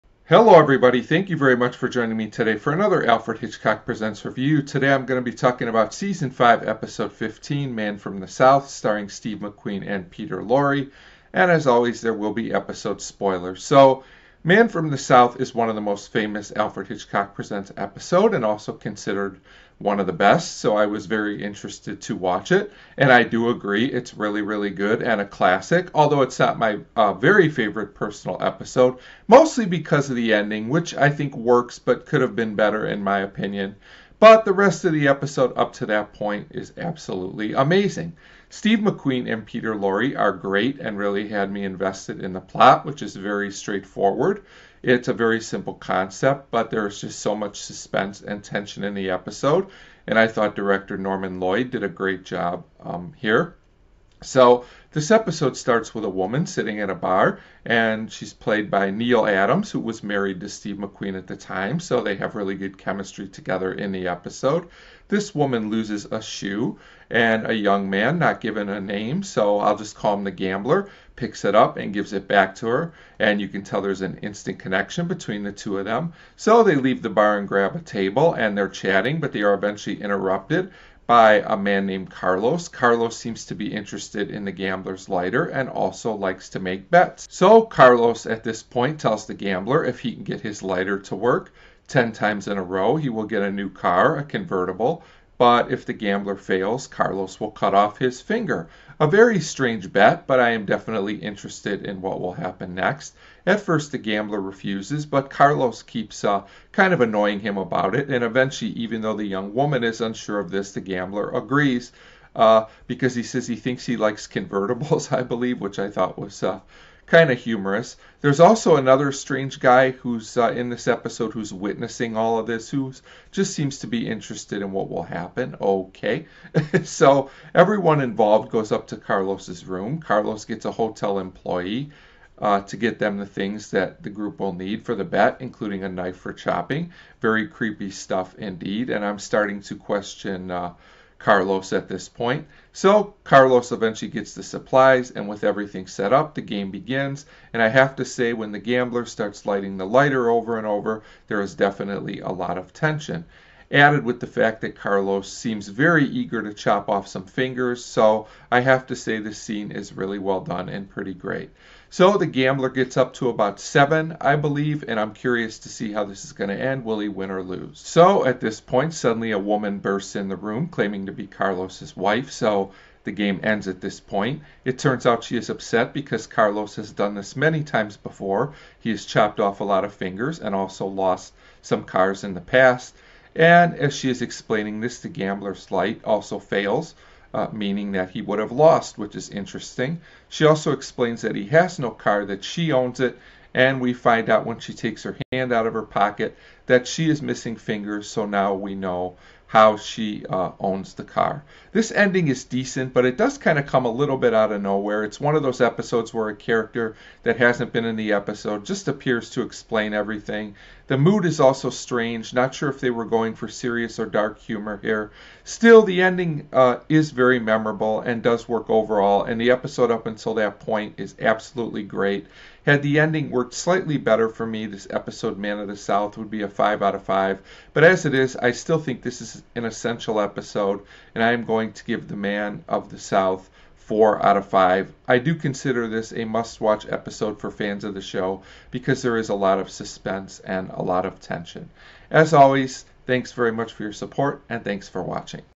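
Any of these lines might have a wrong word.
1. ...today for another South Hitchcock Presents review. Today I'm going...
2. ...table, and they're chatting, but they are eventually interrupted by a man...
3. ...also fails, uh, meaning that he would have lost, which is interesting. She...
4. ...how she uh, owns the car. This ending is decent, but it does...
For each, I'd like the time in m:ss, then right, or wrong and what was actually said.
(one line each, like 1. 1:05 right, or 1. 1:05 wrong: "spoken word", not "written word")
1. 0:02 wrong: "Alfred", not "South"
2. 1:17 right
3. 3:06 right
4. 3:19 right.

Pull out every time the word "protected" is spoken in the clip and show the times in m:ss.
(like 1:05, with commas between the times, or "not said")
not said.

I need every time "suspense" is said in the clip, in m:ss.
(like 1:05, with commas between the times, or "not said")
0:47, 3:59.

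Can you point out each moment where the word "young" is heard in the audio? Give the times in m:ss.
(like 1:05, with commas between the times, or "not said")
1:07, 1:49.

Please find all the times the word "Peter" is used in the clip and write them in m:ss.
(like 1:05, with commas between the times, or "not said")
0:10, 0:39.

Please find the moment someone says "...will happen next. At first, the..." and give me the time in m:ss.
1:42.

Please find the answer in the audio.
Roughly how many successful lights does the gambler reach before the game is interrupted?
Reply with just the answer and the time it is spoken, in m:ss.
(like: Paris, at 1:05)
7, at 2:43.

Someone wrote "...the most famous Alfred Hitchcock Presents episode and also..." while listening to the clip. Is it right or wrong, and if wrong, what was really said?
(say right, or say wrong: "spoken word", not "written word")
right.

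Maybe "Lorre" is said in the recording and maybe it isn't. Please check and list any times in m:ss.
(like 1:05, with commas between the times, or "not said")
0:10, 0:39.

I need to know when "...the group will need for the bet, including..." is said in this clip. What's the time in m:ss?
2:14.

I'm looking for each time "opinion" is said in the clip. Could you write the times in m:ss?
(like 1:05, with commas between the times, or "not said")
0:33.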